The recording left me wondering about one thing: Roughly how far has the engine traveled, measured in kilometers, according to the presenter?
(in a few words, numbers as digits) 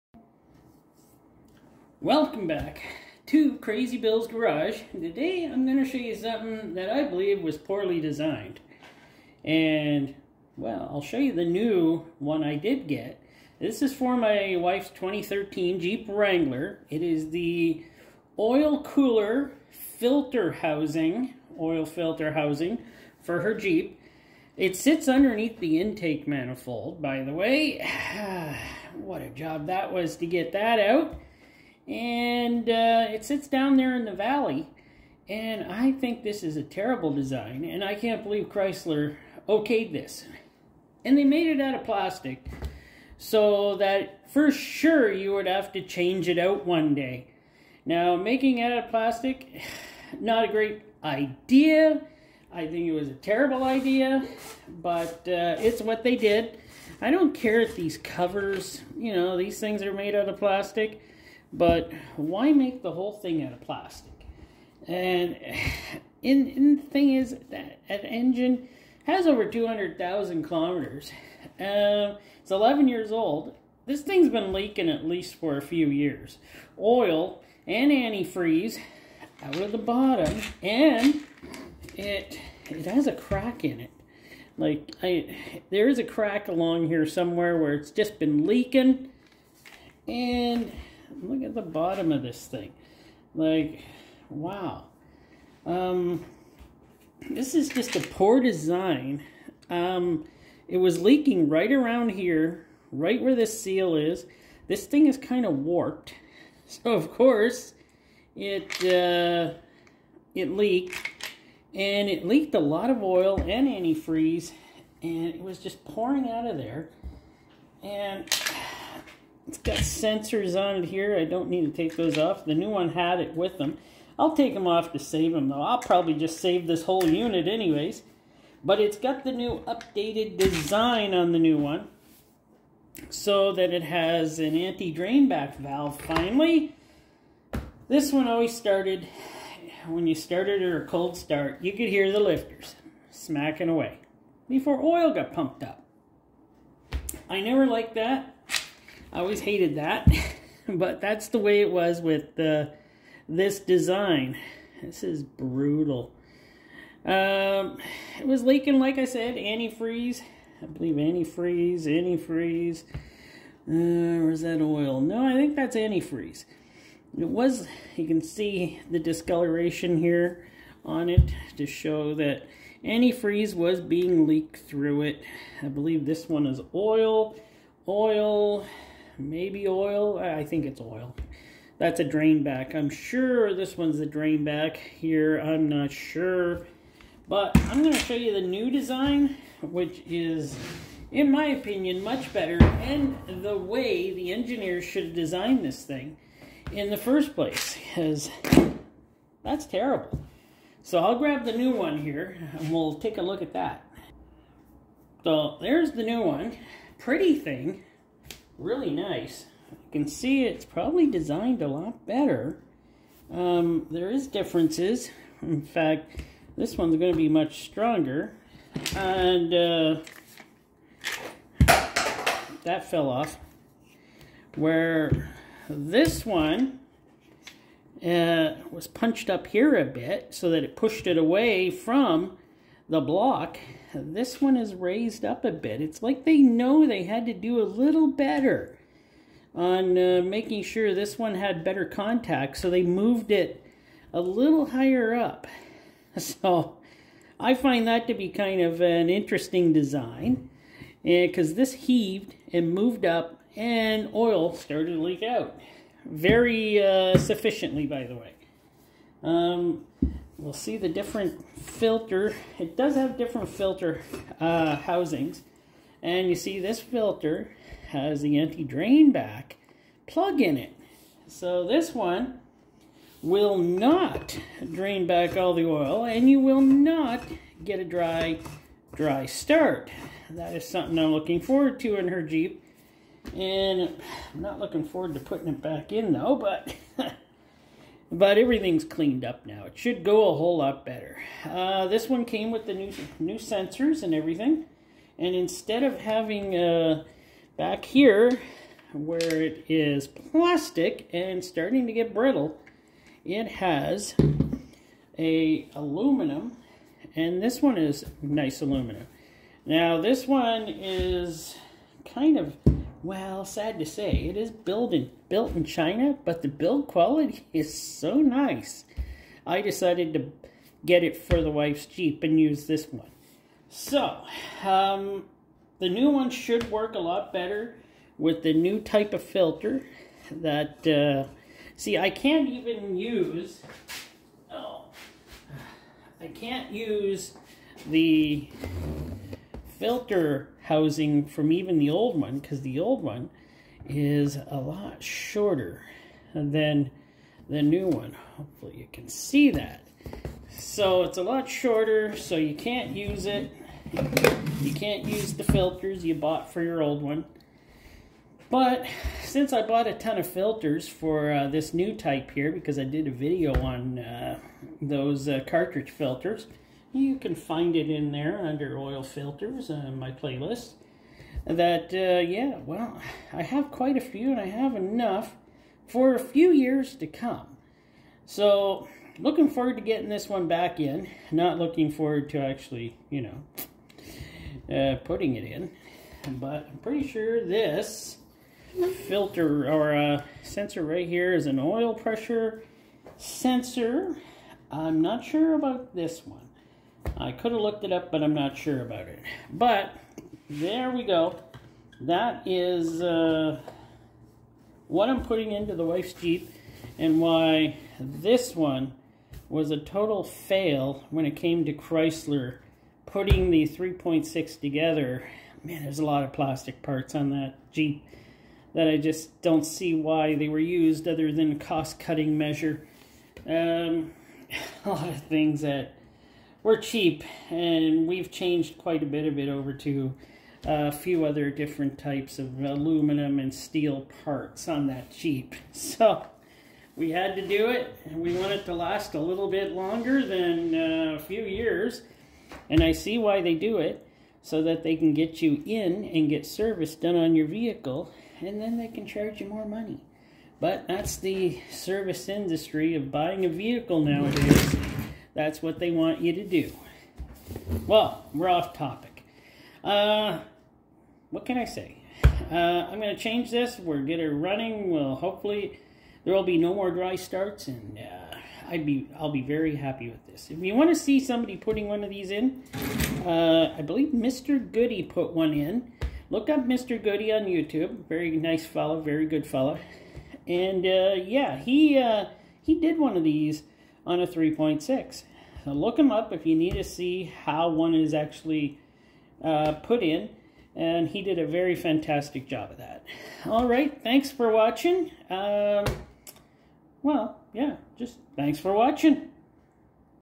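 Over 200,000 kilometers.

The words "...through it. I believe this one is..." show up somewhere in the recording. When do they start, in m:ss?
2:54.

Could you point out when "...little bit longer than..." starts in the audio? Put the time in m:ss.
7:19.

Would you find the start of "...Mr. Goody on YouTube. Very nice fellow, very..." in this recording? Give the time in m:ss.
7:56.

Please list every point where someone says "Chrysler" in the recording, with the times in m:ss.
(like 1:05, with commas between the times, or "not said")
0:38, 6:51.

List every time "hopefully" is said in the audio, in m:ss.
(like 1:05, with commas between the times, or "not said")
5:48, 7:45.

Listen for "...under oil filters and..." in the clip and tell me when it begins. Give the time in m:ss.
6:08.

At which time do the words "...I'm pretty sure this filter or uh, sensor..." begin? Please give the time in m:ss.
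6:26.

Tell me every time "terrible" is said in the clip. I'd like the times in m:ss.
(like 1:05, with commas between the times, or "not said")
0:36, 0:53, 3:19.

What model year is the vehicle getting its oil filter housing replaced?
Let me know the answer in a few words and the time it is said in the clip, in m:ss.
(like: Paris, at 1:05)
2013, at 0:14.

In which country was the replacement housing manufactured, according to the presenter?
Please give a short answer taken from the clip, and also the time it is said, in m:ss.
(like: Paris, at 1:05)
China, at 5:15.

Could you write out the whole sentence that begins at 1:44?
This thing is kind of warped.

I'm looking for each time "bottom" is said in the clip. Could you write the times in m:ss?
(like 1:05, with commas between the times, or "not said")
1:19, 1:31.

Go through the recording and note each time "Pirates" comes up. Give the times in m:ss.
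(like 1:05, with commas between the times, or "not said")
not said.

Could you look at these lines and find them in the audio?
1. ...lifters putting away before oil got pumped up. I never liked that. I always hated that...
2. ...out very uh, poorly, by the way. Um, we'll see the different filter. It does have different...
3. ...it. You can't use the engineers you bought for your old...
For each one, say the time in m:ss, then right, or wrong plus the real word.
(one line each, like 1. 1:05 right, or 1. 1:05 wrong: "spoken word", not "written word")
1. 2:22 wrong: "smacking", not "putting"
2. 4:15 wrong: "sufficiently", not "poorly"
3. 5:53 wrong: "filters", not "engineers".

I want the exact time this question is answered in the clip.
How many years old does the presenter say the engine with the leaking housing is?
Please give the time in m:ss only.
1:12.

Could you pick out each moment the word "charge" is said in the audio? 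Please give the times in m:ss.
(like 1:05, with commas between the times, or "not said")
7:29.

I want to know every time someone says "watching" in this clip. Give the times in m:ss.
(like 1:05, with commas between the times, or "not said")
8:14, 8:18.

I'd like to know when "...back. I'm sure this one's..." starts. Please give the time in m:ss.
3:02.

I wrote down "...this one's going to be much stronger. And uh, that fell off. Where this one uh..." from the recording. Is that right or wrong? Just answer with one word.
right.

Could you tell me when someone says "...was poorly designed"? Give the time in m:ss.
0:07.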